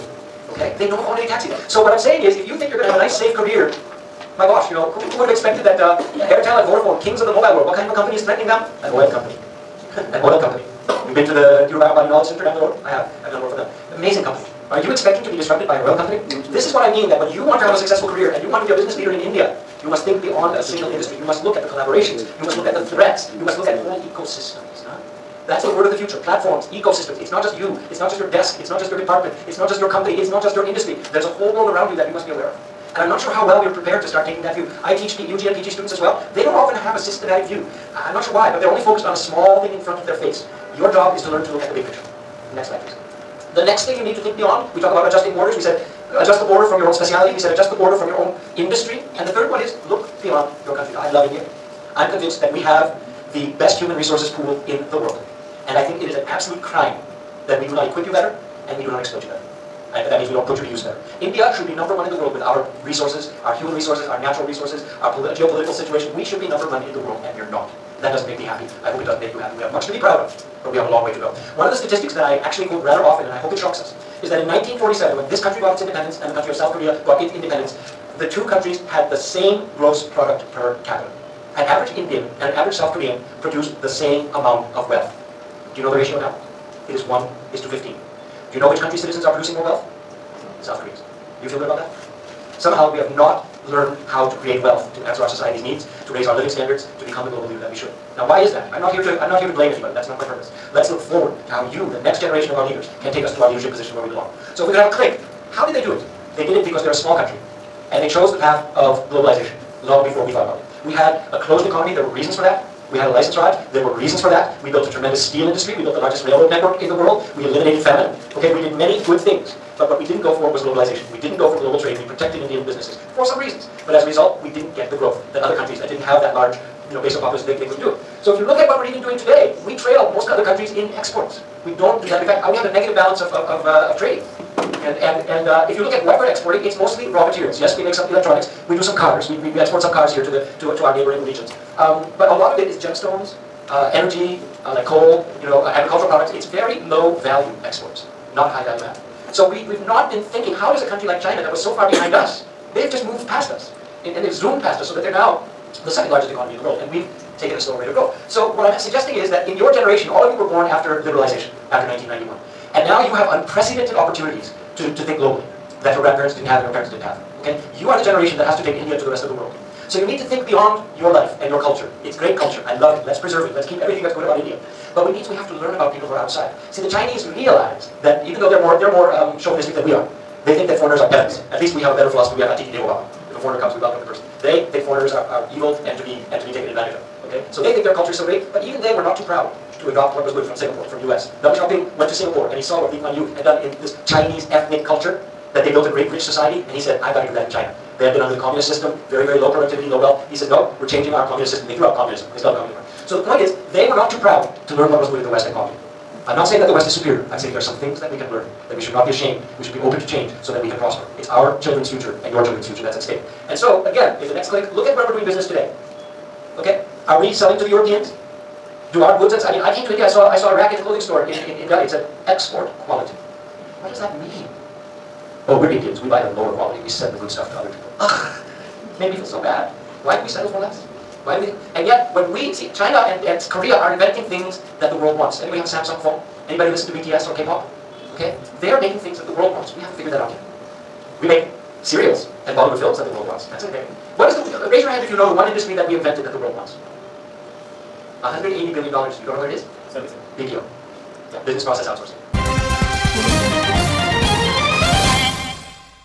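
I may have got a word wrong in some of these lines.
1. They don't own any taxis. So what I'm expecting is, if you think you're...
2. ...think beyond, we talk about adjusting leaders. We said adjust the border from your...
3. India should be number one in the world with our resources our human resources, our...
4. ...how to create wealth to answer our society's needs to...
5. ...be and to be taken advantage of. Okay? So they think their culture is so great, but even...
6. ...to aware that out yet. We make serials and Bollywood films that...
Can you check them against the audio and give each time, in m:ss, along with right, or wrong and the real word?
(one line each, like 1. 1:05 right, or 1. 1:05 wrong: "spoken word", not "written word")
1. 0:00 wrong: "saying", not "expecting"
2. 0:44 wrong: "borders", not "leaders"
3. 1:01 right
4. 1:34 right
5. 3:06 right
6. 3:59 wrong: "figure", not "aware".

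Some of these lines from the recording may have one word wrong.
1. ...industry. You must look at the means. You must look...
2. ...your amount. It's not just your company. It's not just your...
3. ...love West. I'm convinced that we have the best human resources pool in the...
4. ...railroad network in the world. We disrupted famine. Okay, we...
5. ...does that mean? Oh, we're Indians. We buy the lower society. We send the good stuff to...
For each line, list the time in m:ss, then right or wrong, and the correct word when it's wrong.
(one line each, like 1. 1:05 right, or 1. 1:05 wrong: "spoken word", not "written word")
1. 0:20 wrong: "collaborations", not "means"
2. 0:28 wrong: "department", not "amount"
3. 0:51 wrong: "India", not "West"
4. 1:56 wrong: "eliminated", not "disrupted"
5. 3:43 wrong: "quality", not "society".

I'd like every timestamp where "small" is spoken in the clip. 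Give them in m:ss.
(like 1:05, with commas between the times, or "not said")
0:39, 1:46.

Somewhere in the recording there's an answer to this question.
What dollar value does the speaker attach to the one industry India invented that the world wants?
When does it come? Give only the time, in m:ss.
4:08.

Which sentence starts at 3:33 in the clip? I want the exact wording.
And so, again, if the next click, look at where we're doing business today.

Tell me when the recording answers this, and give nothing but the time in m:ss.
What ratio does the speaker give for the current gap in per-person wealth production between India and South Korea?
1:27.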